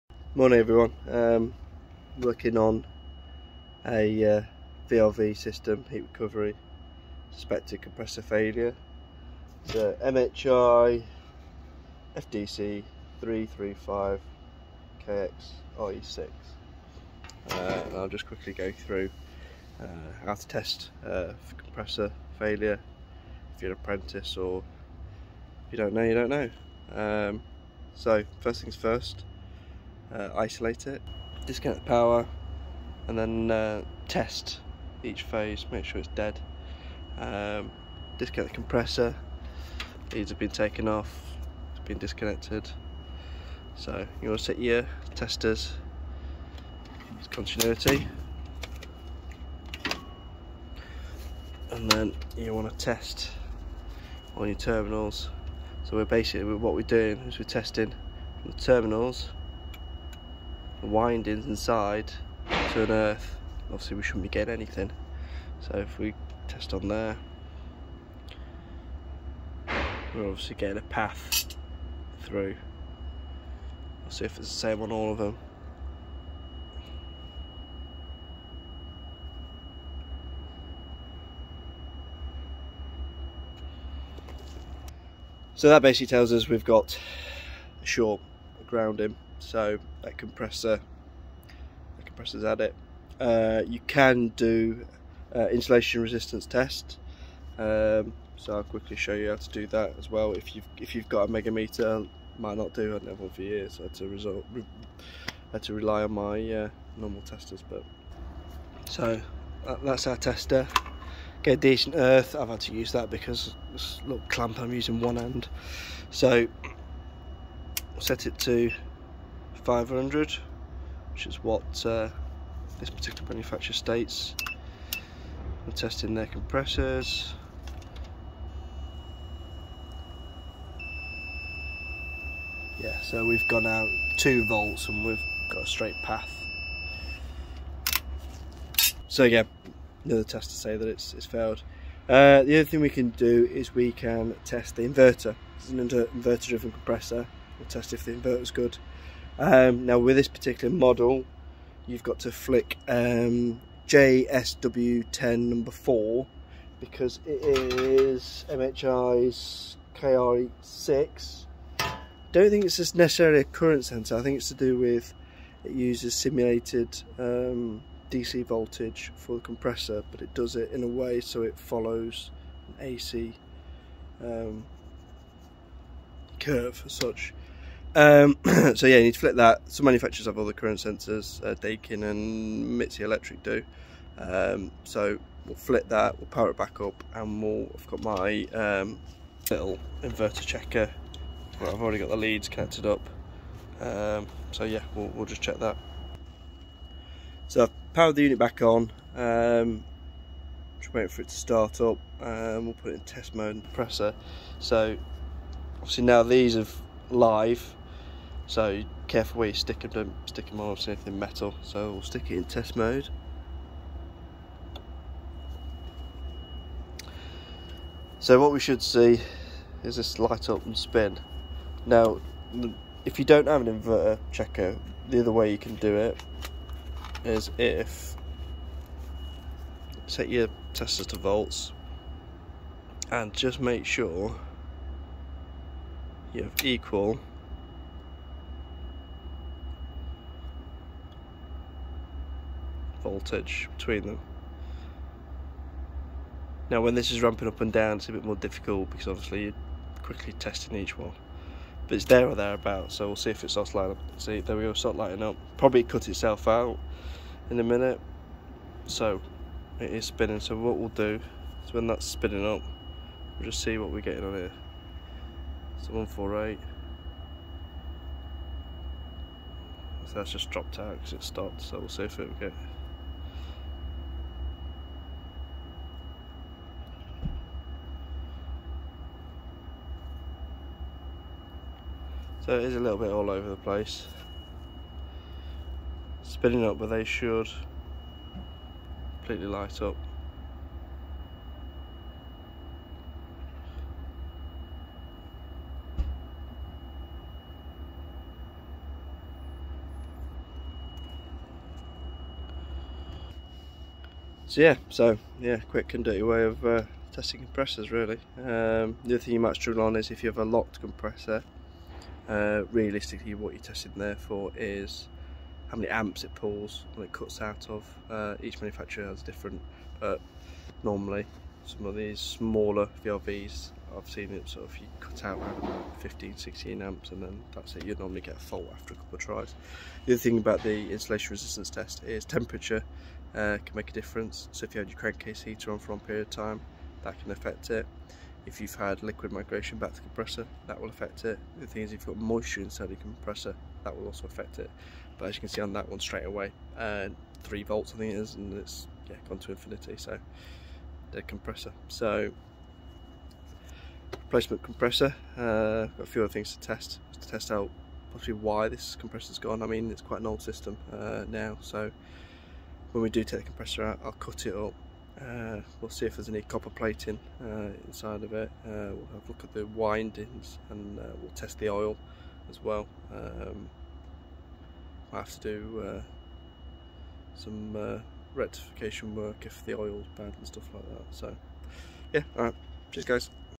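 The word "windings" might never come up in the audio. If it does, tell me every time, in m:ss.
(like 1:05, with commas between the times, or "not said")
1:00, 6:09.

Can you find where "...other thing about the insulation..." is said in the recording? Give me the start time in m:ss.
5:30.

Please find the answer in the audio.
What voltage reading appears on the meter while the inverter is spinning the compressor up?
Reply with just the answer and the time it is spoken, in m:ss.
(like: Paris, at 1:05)
148, at 4:25.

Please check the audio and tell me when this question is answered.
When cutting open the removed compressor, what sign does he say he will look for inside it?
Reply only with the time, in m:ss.
6:06.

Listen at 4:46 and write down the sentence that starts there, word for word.
Spinning up, but they should completely light up.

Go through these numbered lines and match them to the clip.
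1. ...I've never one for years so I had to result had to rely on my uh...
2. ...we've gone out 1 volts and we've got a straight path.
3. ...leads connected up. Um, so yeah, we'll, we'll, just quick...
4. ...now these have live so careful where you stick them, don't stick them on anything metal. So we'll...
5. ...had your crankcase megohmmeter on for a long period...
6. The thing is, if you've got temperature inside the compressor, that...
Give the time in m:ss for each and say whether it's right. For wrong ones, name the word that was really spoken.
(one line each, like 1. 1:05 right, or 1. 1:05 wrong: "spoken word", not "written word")
1. 1:42 right
2. 2:13 wrong: "2", not "1"
3. 3:12 wrong: "check", not "quick"
4. 3:26 right
5. 5:34 wrong: "heater", not "megohmmeter"
6. 5:41 wrong: "moisture", not "temperature".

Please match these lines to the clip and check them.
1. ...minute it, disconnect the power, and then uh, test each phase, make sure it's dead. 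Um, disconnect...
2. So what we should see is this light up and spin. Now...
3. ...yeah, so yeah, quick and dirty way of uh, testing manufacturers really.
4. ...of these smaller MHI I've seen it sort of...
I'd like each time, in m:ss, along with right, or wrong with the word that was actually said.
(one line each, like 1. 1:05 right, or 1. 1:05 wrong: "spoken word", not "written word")
1. 0:30 wrong: "isolate", not "minute"
2. 3:38 right
3. 5:04 wrong: "compressors", not "manufacturers"
4. 5:21 wrong: "VRVs", not "MHI".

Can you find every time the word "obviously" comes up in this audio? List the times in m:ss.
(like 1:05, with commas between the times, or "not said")
1:03, 1:10, 3:25, 4:09.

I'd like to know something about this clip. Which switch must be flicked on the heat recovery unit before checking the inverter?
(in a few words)
JSW10 number 4.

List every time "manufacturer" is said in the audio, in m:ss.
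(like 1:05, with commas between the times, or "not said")
2:03, 2:59, 5:18.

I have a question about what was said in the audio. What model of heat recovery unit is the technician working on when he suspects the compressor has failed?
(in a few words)
MHI FDC 335KX RE6.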